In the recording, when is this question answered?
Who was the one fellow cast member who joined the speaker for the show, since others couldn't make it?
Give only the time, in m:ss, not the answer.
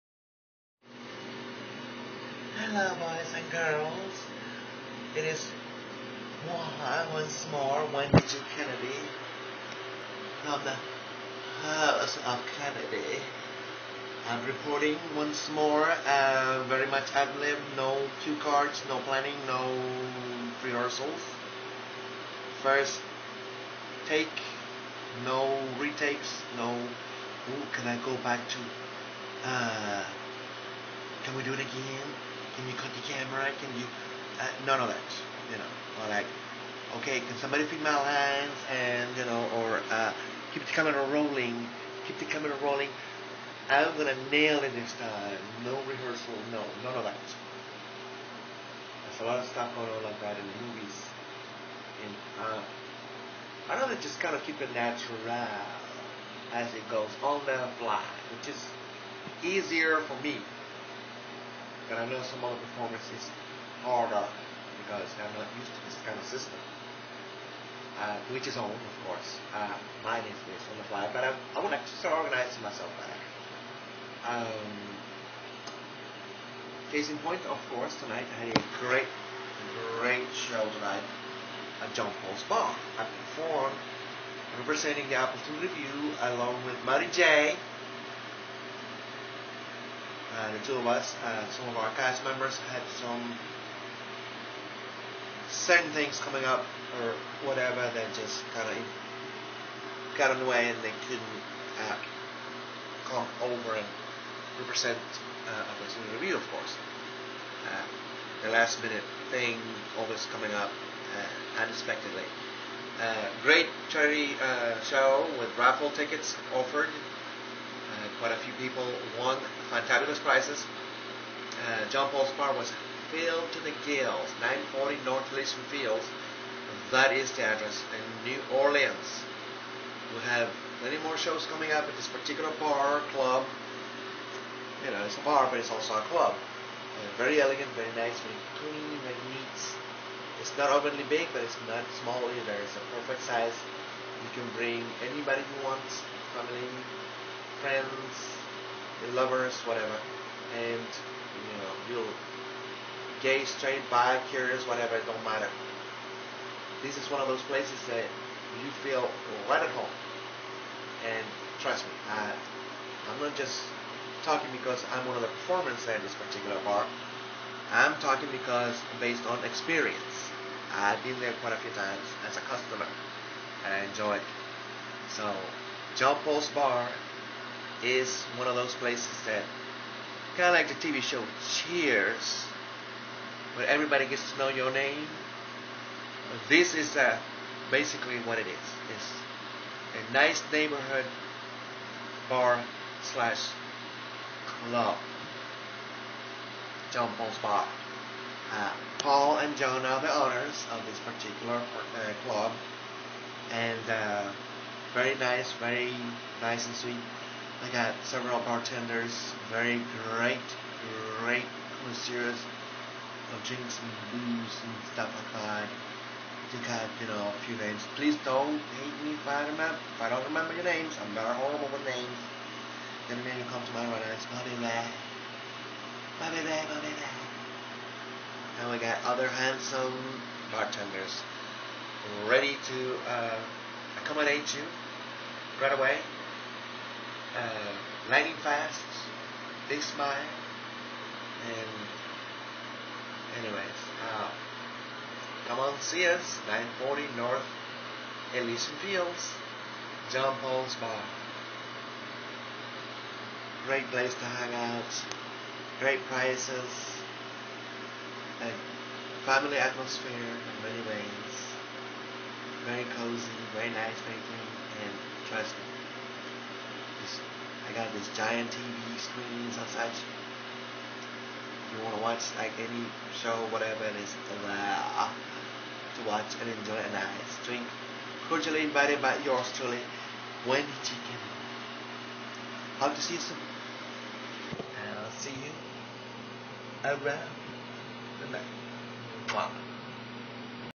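1:26.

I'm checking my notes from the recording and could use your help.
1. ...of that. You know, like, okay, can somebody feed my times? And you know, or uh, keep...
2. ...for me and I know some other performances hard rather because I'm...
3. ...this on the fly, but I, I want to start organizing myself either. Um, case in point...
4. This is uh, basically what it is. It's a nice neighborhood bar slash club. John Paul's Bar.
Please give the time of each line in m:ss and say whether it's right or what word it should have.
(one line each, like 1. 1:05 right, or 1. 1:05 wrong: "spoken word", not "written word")
1. 0:34 wrong: "lines", not "times"
2. 1:00 wrong: "harder", not "rather"
3. 1:10 wrong: "better", not "either"
4. 3:06 right.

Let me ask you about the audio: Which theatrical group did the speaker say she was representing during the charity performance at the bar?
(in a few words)
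Appleton Review.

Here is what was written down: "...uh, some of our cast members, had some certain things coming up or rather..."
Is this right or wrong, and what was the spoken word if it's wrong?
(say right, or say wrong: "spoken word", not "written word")
wrong: "whatever", not "rather".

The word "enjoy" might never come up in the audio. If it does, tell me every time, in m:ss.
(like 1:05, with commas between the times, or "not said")
2:53, 4:36.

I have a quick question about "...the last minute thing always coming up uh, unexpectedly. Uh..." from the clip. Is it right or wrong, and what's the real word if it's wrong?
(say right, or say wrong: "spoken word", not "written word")
right.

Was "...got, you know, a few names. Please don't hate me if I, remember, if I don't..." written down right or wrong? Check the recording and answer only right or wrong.
right.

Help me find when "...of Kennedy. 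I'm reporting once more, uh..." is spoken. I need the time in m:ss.
0:12.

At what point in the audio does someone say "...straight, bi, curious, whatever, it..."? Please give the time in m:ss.
2:33.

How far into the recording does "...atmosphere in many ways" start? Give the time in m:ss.
4:19.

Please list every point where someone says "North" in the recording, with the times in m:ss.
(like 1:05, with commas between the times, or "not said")
2:05, 4:07.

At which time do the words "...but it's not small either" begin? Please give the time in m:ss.
2:21.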